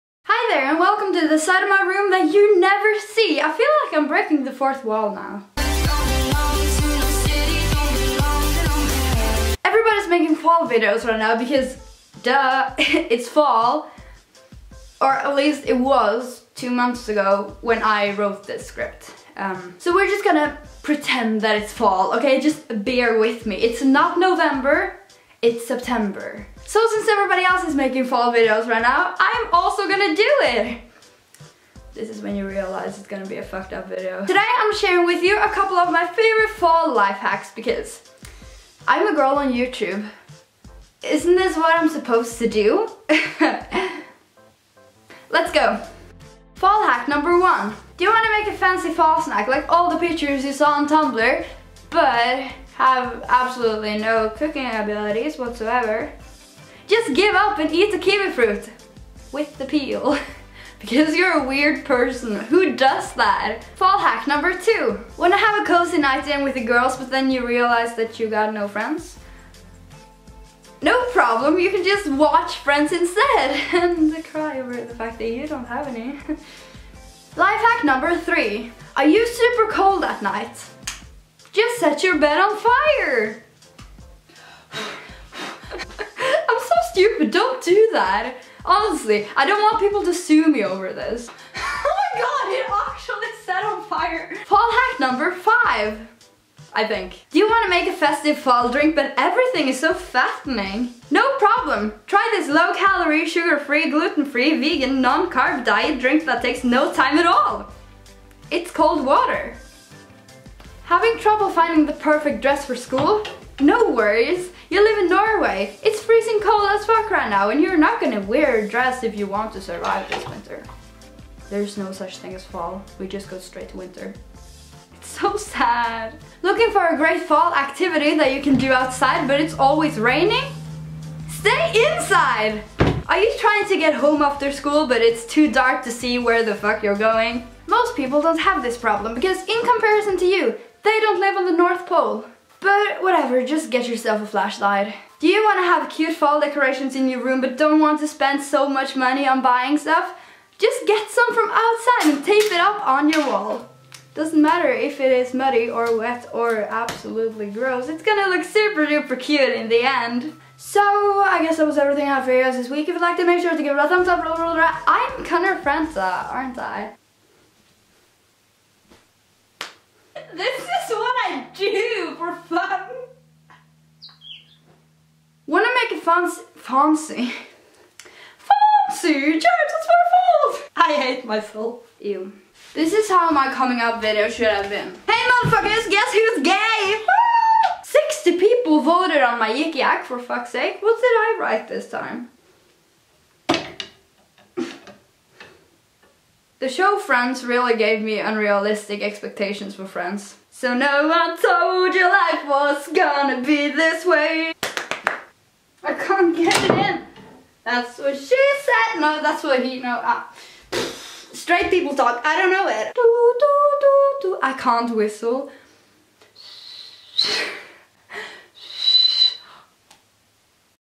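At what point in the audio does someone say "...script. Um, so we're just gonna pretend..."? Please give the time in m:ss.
0:18.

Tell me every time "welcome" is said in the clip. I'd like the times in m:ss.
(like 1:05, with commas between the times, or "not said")
0:00.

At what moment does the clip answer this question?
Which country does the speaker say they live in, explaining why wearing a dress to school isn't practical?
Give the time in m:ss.
1:55.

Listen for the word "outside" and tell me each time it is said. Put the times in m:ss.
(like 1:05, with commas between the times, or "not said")
2:08, 2:31.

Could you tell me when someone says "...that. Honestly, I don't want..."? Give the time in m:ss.
1:27.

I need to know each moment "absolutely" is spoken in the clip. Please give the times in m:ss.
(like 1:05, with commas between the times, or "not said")
0:53, 2:36.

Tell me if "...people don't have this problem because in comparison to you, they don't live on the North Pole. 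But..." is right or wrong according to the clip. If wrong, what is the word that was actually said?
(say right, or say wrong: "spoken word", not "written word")
right.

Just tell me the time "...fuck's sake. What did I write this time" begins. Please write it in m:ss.
3:10.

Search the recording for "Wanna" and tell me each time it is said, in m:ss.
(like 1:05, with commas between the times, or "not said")
1:05, 2:55.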